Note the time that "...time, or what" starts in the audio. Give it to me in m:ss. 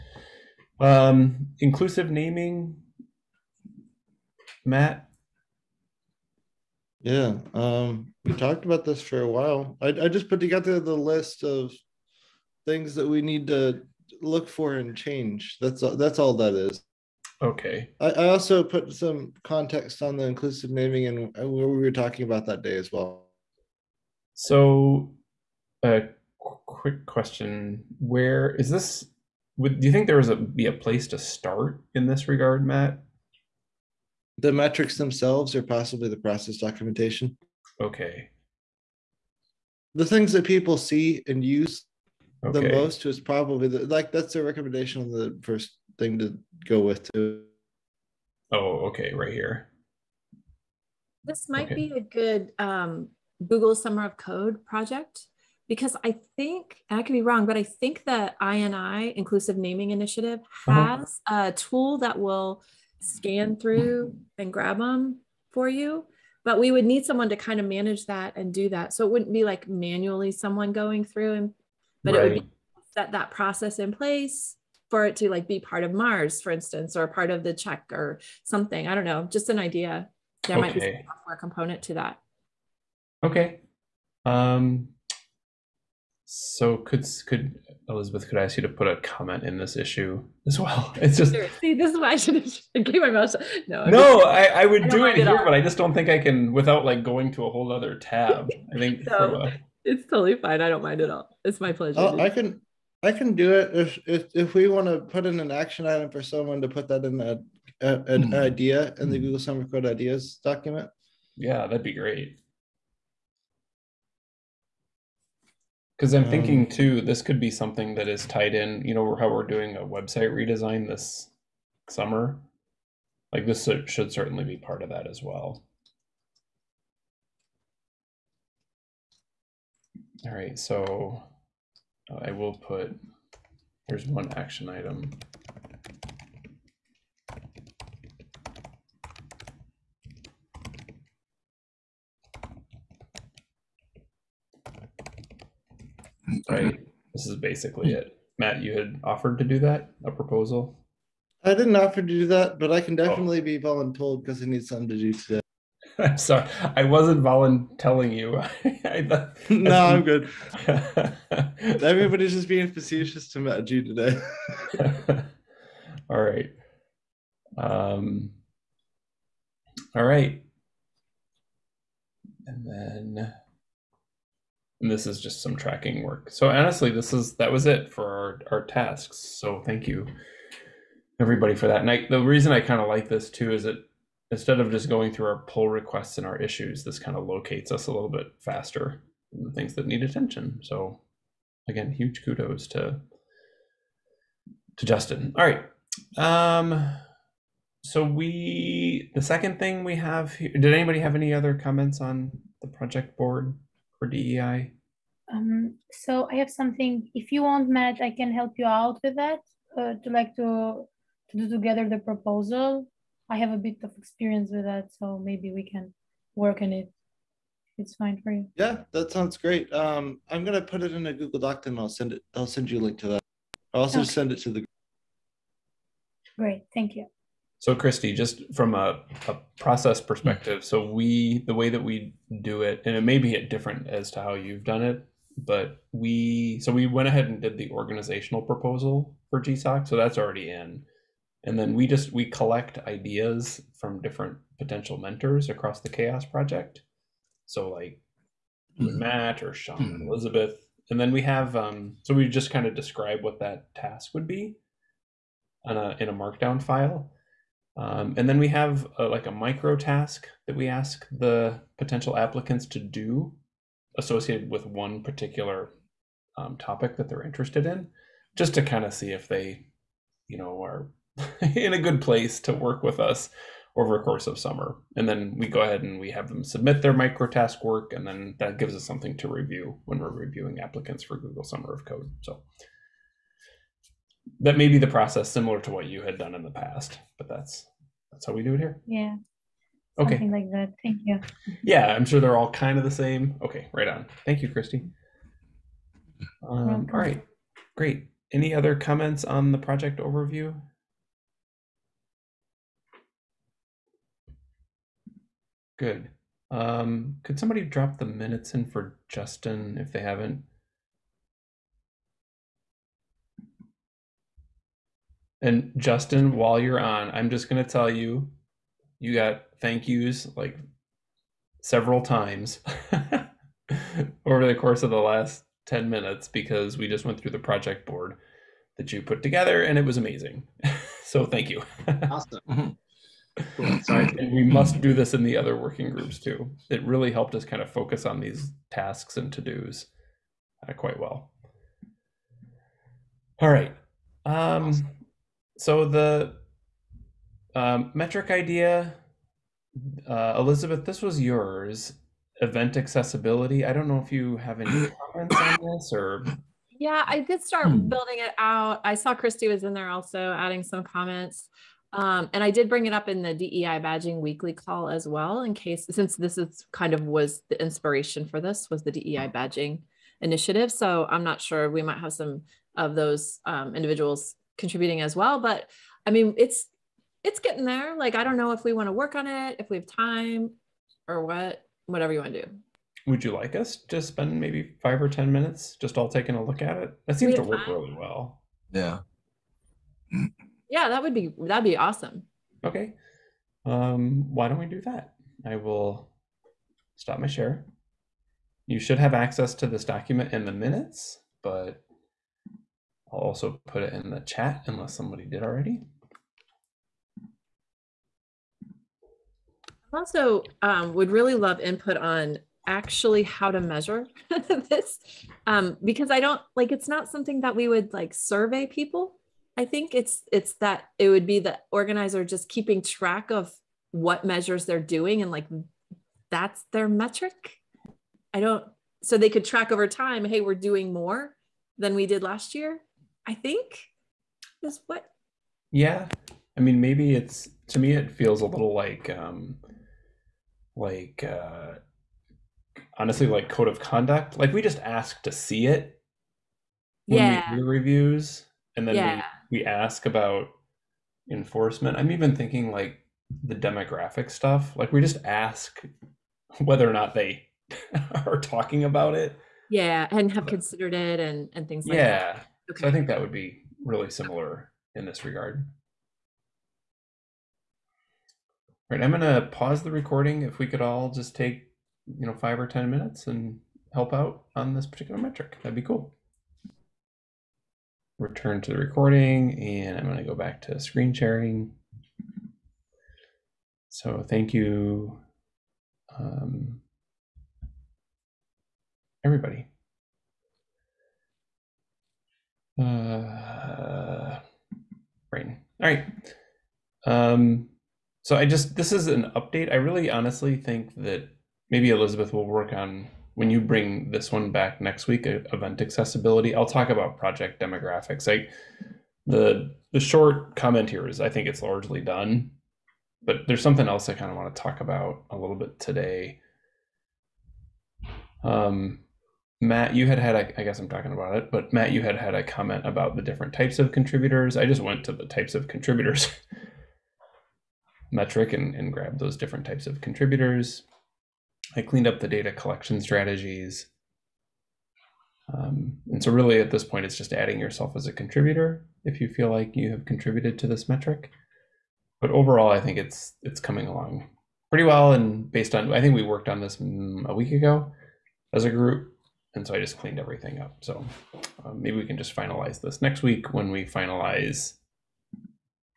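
6:19.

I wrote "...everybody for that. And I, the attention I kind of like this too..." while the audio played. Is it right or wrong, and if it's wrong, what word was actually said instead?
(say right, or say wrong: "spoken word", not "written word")
wrong: "reason", not "attention".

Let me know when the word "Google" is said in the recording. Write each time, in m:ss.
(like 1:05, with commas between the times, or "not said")
0:53, 1:49, 3:41, 4:41.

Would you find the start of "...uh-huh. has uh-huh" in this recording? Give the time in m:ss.
1:00.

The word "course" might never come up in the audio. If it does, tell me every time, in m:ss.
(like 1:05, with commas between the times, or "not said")
4:34, 5:24.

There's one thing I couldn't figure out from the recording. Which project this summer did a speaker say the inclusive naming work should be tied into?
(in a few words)
website redesign.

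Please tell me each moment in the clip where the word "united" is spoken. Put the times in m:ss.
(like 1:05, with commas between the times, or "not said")
not said.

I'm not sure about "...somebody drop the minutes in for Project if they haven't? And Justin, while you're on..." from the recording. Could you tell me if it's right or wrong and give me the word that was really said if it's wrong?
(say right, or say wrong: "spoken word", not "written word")
wrong: "Justin", not "Project".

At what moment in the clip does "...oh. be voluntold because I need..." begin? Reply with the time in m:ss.
2:33.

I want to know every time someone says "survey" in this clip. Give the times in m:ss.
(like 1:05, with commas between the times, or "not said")
6:58.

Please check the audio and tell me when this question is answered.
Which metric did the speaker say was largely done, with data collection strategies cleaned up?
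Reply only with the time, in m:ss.
8:27.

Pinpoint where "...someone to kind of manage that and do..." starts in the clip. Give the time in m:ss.
1:07.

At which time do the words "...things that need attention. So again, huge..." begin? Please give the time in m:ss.
3:09.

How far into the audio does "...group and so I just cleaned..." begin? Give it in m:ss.
9:08.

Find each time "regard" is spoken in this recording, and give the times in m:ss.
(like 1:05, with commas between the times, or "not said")
0:32, 7:45.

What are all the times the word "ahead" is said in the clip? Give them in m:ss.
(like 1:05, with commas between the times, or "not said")
3:57, 4:35.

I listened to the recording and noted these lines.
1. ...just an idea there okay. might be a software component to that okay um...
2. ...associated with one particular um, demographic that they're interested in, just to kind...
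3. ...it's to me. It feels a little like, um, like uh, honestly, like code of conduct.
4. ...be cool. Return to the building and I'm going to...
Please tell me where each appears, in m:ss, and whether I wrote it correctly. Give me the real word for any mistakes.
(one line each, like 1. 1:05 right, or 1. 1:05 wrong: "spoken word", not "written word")
1. 1:19 right
2. 4:23 wrong: "topic", not "demographic"
3. 7:17 right
4. 7:55 wrong: "recording", not "building".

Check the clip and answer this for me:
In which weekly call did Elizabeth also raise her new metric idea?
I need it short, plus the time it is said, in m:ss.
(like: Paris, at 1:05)
DEI badging weekly call, at 6:03.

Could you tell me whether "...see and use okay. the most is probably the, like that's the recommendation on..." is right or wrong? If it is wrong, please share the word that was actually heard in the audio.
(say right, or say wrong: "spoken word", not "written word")
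right.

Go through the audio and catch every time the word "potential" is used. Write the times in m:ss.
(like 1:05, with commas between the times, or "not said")
4:04, 4:21.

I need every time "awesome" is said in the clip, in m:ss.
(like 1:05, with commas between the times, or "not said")
5:32, 5:44, 6:31.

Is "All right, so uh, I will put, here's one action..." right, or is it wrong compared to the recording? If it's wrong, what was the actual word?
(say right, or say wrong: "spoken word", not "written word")
right.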